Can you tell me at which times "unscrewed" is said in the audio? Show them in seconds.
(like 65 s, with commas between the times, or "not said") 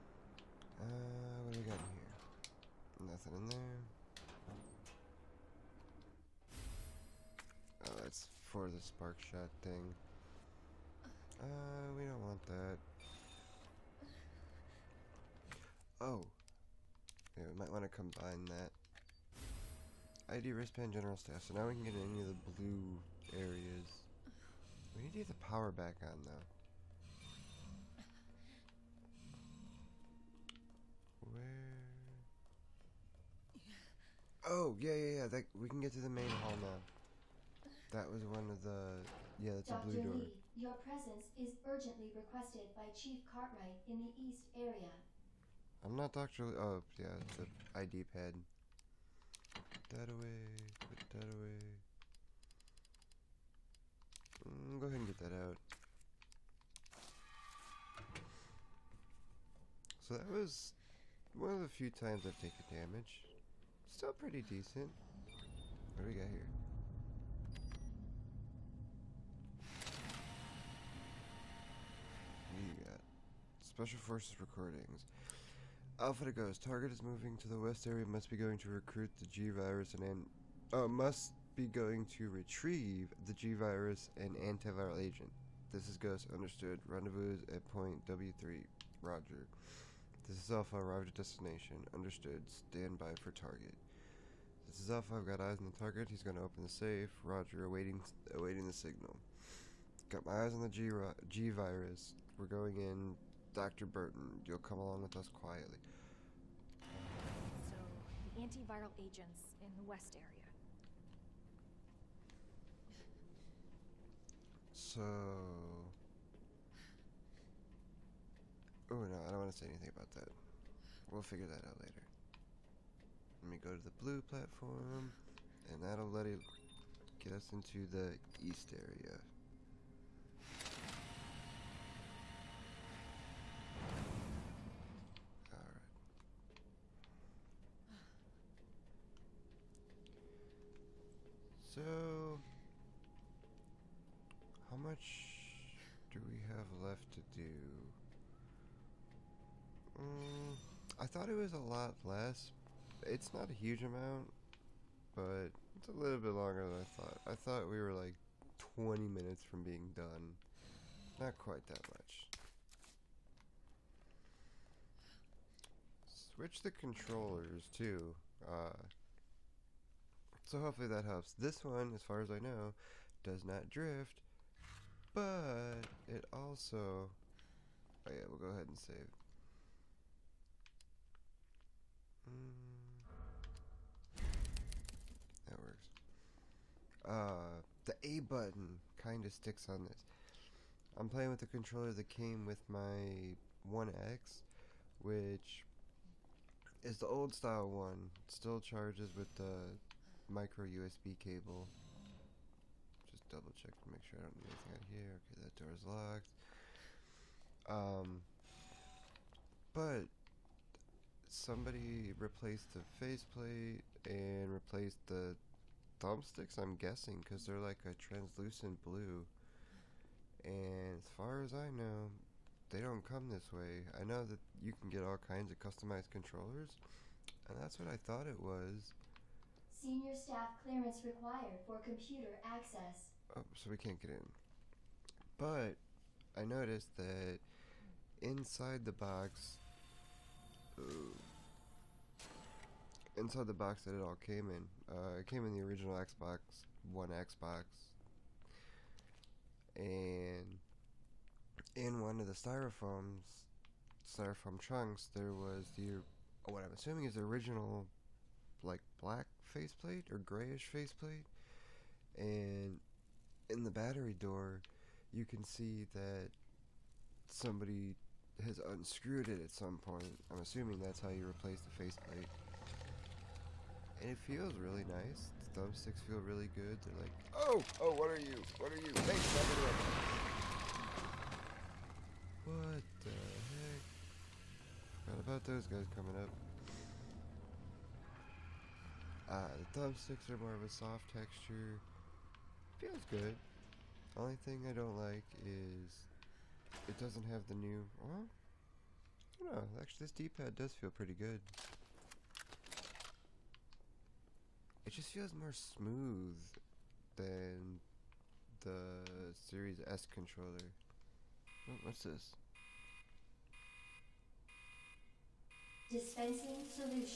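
268 s.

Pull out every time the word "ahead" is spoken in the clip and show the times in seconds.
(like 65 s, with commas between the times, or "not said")
54 s, 178 s.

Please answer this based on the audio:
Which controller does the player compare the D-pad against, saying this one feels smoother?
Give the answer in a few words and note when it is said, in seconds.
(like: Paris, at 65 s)
Series S controller, at 309 s.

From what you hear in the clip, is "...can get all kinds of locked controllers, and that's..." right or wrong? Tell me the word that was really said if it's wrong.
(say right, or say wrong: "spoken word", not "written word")
wrong: "customized", not "locked".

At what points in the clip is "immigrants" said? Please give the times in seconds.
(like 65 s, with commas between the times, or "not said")
not said.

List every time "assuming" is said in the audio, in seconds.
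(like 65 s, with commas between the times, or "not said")
256 s, 270 s.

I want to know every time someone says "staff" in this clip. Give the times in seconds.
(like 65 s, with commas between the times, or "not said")
21 s, 230 s.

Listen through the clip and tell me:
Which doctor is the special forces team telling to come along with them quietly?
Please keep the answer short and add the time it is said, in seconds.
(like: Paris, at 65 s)
Dr. Birkin, at 103 s.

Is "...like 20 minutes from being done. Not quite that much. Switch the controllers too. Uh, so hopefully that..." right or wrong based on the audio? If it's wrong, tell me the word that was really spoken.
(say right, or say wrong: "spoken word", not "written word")
right.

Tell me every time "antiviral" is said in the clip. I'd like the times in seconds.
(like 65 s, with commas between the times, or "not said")
84 s, 108 s.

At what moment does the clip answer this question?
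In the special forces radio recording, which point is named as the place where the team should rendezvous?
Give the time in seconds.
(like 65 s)
87 s.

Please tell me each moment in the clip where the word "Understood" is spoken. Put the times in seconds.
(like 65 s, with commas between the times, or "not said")
86 s, 91 s.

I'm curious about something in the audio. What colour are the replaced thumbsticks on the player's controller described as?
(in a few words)
Translucent blue.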